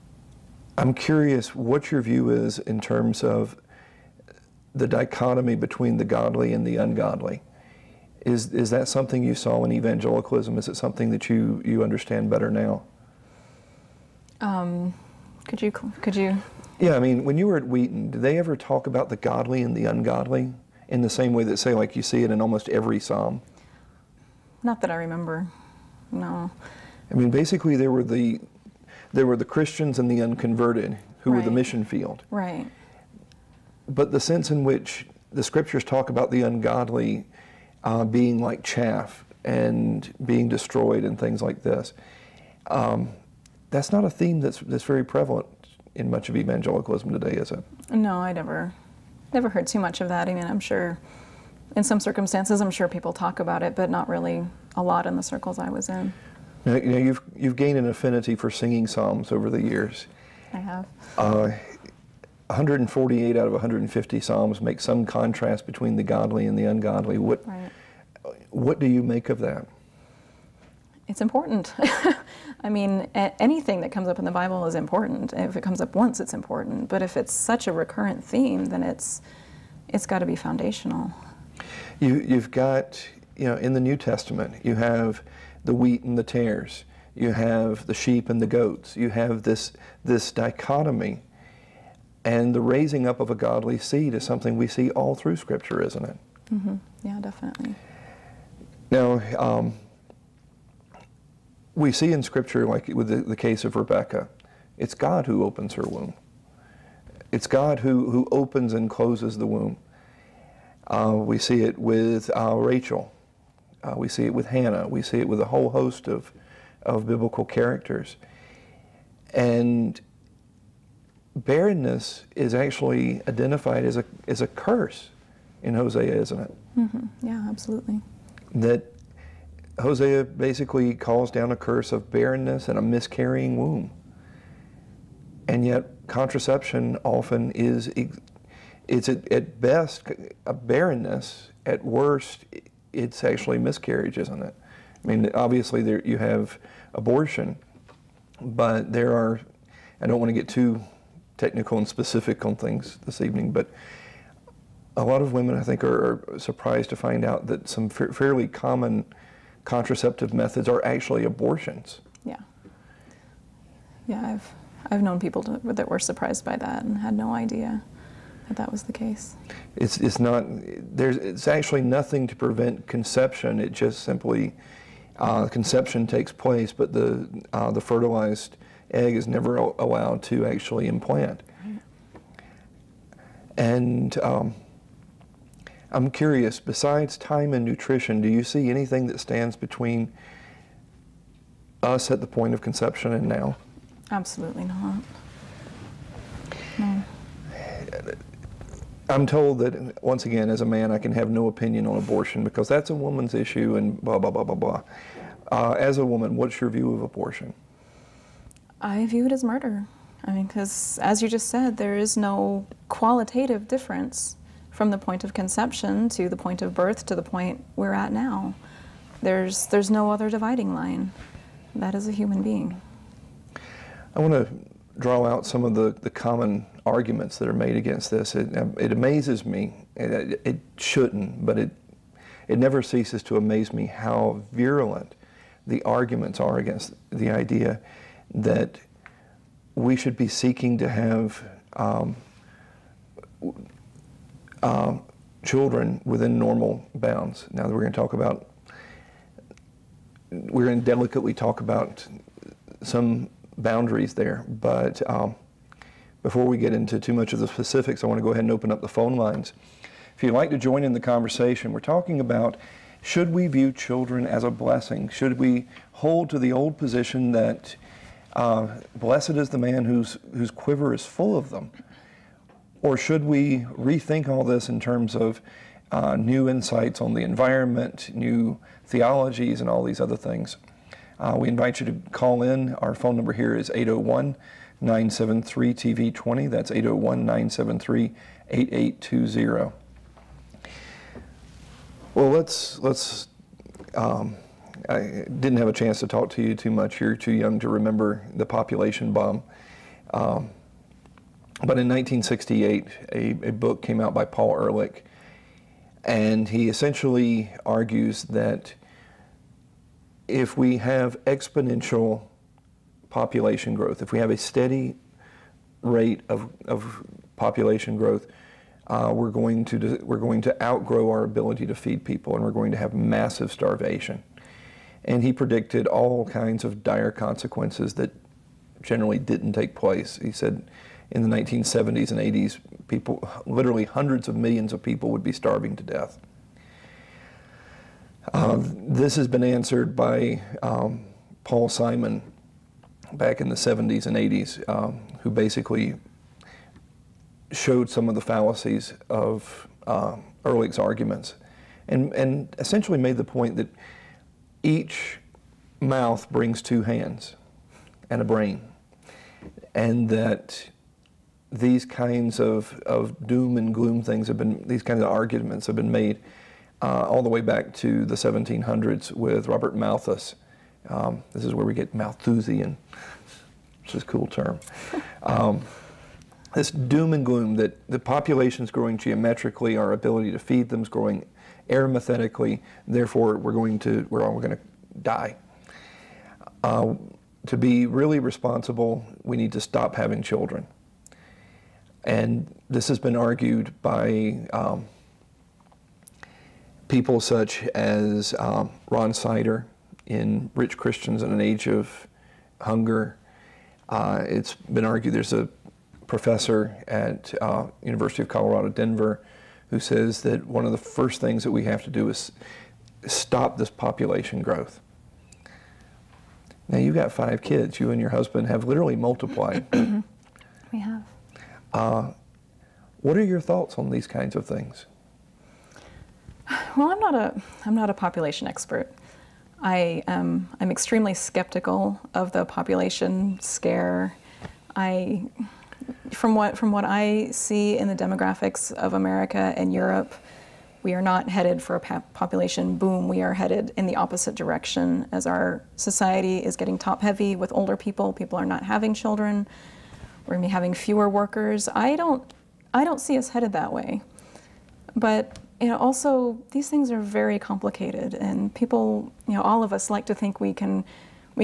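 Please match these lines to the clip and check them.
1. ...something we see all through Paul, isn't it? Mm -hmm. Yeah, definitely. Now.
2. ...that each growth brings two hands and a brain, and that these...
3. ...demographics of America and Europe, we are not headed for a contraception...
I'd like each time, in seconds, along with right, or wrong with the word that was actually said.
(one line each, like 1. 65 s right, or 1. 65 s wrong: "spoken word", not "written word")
1. 94 s wrong: "Scripture", not "Paul"
2. 353 s wrong: "mouth", not "growth"
3. 437 s wrong: "population", not "contraception".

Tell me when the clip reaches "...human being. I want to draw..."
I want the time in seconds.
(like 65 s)
222 s.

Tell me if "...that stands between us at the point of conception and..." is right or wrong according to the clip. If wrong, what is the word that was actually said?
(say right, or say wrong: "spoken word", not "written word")
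right.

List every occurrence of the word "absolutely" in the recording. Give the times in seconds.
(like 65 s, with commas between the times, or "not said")
127 s, 194 s.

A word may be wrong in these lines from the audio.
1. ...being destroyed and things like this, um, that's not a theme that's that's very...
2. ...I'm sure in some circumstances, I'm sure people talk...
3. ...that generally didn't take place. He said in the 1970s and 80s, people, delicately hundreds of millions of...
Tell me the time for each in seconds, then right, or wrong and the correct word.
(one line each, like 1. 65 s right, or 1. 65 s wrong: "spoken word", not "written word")
1. 40 s right
2. 50 s right
3. 327 s wrong: "literally", not "delicately".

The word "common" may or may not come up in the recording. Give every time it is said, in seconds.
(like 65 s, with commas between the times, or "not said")
158 s, 226 s.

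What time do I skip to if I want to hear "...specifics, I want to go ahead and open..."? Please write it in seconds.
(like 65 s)
257 s.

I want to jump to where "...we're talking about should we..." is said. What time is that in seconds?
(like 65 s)
261 s.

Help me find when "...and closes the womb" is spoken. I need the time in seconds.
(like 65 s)
108 s.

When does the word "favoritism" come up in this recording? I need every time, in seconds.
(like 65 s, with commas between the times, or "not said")
not said.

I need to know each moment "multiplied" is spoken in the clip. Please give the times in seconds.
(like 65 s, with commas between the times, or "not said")
418 s.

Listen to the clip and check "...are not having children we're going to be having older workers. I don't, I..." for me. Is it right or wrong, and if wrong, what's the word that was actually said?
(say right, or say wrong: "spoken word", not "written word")
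wrong: "fewer", not "older".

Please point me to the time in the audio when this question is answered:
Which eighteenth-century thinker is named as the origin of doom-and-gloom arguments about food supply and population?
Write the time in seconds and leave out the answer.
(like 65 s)
369 s.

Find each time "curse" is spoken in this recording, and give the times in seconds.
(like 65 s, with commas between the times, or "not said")
124 s, 131 s.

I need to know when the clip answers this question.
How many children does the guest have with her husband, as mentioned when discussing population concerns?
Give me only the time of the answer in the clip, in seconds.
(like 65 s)
417 s.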